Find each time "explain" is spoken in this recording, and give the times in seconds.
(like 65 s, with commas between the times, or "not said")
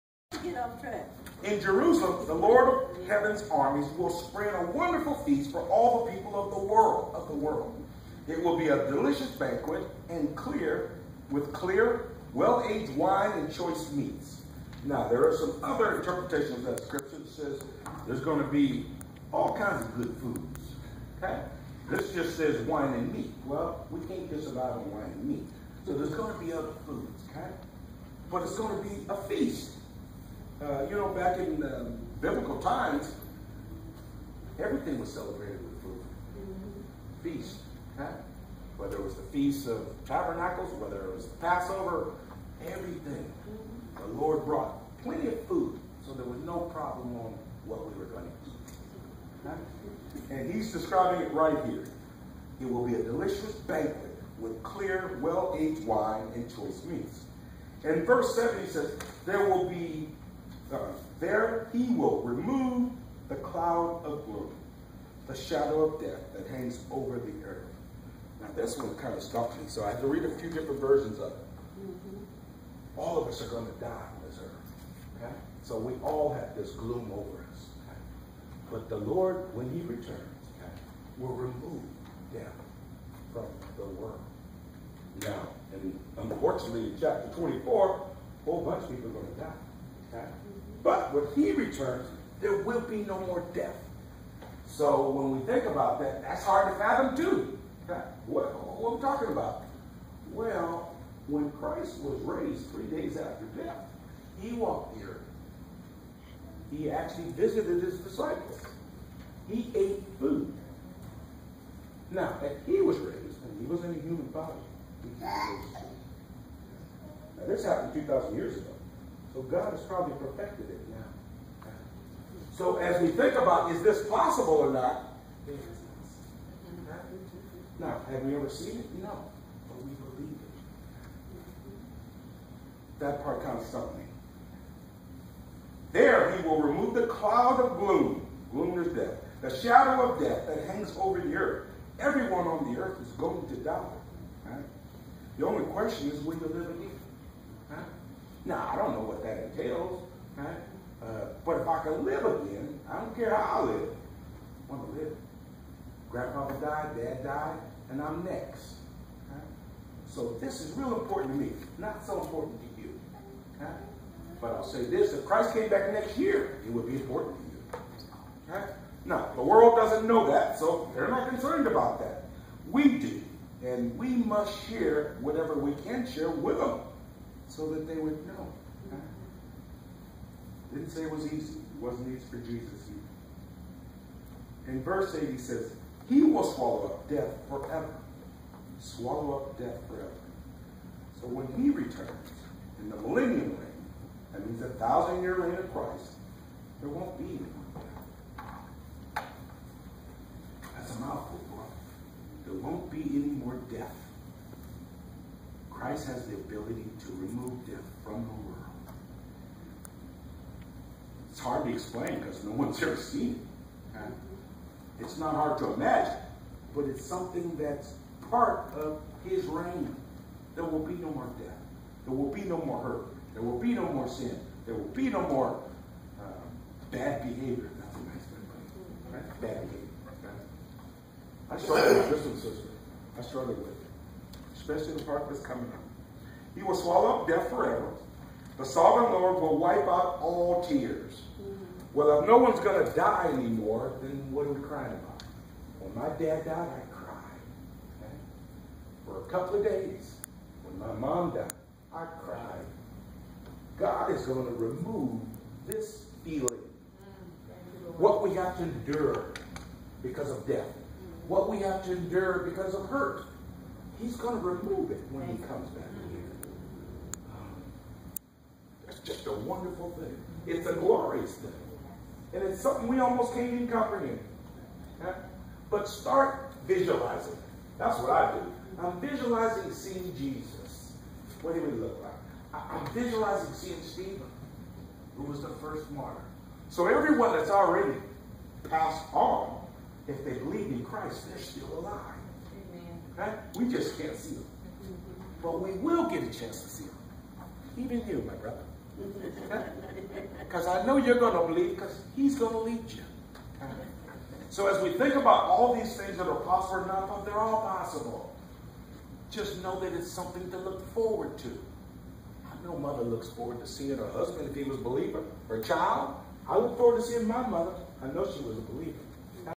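211 s.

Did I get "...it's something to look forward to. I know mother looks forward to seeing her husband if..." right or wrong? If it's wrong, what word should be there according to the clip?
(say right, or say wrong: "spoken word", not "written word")
right.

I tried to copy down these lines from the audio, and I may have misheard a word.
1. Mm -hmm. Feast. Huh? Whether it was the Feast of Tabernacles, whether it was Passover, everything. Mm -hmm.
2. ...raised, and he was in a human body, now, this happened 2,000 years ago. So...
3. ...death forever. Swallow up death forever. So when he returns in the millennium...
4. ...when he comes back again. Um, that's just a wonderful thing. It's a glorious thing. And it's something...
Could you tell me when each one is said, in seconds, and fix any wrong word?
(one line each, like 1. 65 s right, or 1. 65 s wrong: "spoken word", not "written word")
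1. 36 s right
2. 112 s right
3. 187 s right
4. 265 s right.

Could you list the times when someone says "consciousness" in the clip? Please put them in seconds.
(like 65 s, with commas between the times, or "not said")
not said.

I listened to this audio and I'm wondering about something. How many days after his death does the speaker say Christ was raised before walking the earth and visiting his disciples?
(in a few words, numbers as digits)
3.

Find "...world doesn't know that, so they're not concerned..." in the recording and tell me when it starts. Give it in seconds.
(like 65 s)
169 s.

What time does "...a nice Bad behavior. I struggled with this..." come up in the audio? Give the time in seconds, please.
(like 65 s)
227 s.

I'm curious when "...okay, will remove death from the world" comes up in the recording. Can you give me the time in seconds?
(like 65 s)
80 s.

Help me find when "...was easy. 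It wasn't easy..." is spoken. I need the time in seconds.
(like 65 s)
181 s.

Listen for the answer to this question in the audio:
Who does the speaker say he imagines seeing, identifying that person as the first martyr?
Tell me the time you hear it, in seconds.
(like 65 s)
283 s.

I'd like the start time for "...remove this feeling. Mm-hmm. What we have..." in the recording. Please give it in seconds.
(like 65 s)
254 s.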